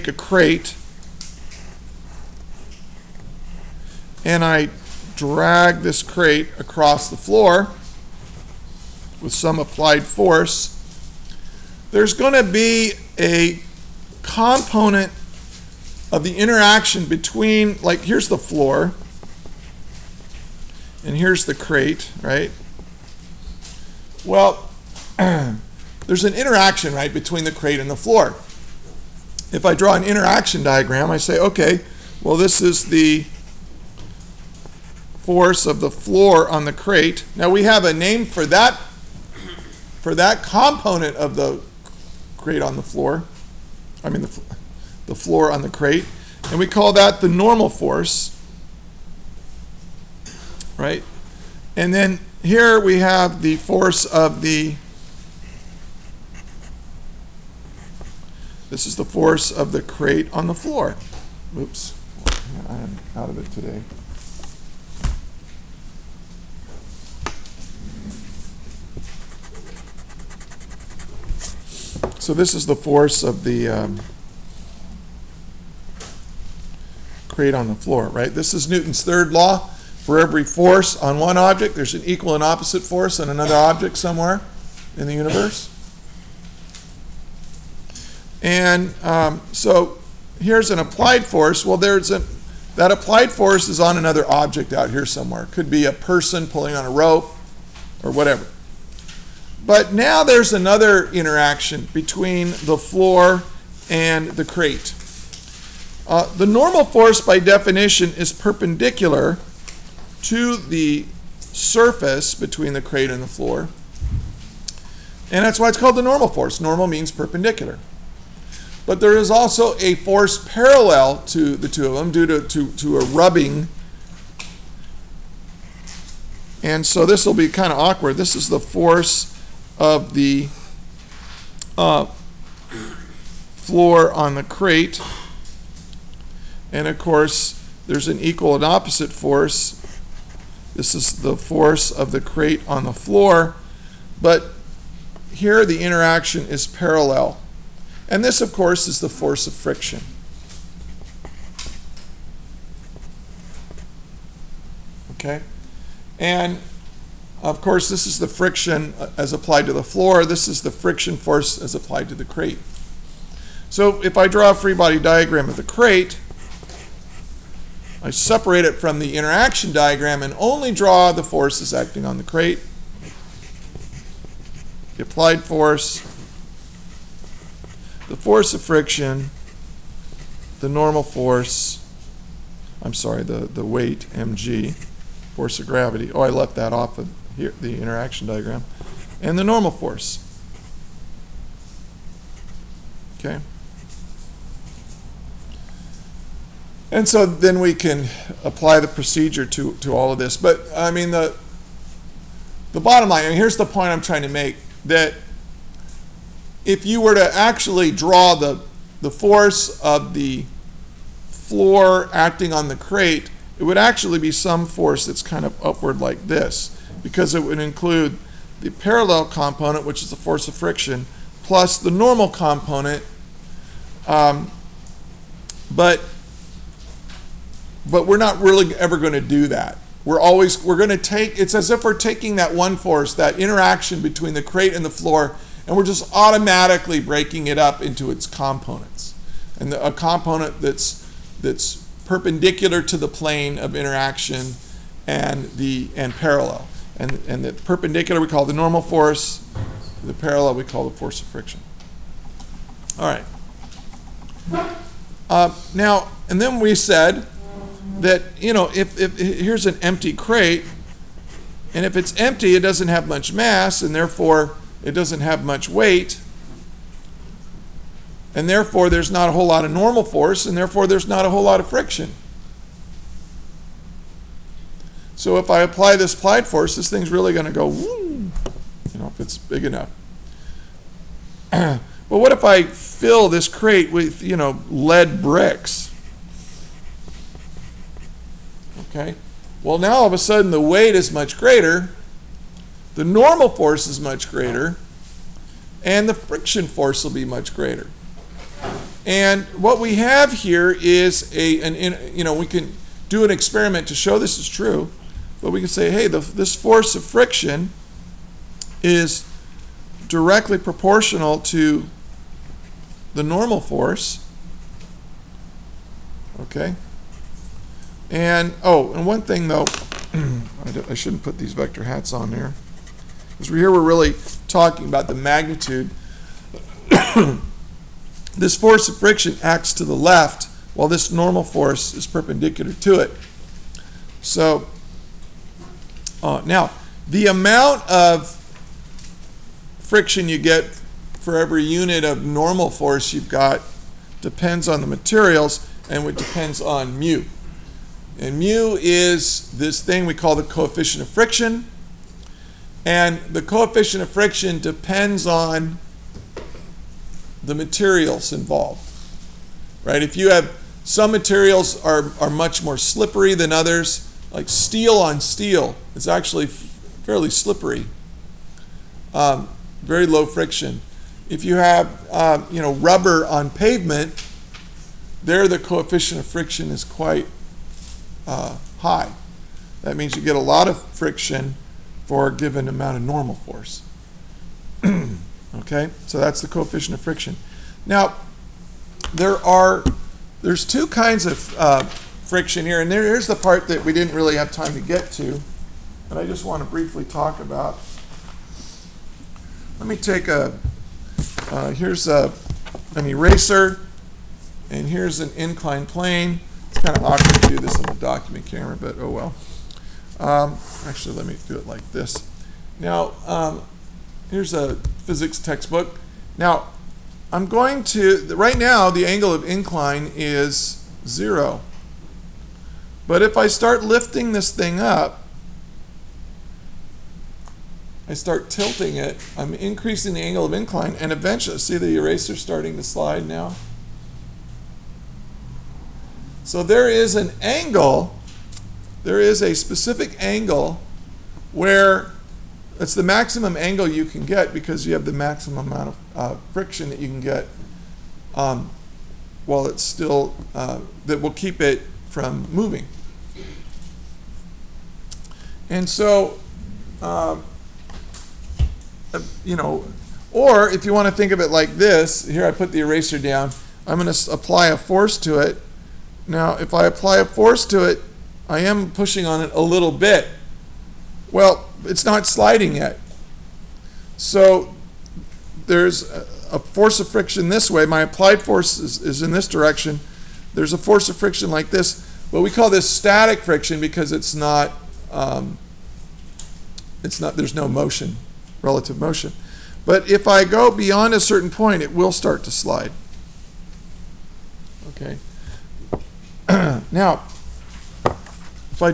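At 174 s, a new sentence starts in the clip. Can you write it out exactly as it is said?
The applied force, the force of friction, the normal force, I'm sorry, the, the weight, mg, force of gravity.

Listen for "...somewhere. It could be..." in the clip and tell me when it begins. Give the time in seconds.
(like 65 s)
95 s.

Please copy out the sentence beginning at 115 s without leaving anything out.
And that's why it's called the normal force.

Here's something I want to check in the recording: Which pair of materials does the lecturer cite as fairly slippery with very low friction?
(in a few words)
steel on steel.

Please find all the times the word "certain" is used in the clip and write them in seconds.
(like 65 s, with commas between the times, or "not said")
491 s.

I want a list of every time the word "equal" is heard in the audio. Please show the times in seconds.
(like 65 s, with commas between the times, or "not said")
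82 s, 138 s.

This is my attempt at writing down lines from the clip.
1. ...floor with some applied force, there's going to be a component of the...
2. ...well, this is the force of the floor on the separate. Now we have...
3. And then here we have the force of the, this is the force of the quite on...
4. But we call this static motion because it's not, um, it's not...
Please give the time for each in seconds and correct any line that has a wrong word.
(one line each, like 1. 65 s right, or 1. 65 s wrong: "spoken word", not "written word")
1. 7 s right
2. 32 s wrong: "crate", not "separate"
3. 51 s wrong: "crate", not "quite"
4. 482 s wrong: "friction", not "motion".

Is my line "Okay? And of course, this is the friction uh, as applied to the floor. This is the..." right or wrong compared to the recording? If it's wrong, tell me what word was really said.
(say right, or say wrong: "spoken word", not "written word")
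right.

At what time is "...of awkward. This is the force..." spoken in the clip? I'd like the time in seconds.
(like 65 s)
127 s.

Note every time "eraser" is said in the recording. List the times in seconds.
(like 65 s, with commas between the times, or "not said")
403 s, 431 s, 462 s.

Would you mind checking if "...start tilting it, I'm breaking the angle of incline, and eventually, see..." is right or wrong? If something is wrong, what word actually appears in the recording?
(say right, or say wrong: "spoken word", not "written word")
wrong: "increasing", not "breaking".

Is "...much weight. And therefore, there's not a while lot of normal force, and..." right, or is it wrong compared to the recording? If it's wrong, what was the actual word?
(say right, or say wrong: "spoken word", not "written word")
wrong: "whole", not "while".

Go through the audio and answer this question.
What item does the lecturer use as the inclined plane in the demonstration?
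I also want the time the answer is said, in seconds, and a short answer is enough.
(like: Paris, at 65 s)
a physics textbook, at 415 s.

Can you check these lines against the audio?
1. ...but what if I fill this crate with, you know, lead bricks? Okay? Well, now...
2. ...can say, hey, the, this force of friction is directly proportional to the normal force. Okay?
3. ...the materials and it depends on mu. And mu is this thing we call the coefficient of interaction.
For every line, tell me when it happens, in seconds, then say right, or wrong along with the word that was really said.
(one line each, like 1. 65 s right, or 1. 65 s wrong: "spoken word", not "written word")
1. 281 s right
2. 305 s right
3. 344 s wrong: "friction", not "interaction".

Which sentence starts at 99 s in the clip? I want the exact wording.
But now there's another interaction between the floor and the crate.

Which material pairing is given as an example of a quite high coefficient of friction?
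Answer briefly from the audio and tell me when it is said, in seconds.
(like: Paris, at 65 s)
rubber on pavement, at 372 s.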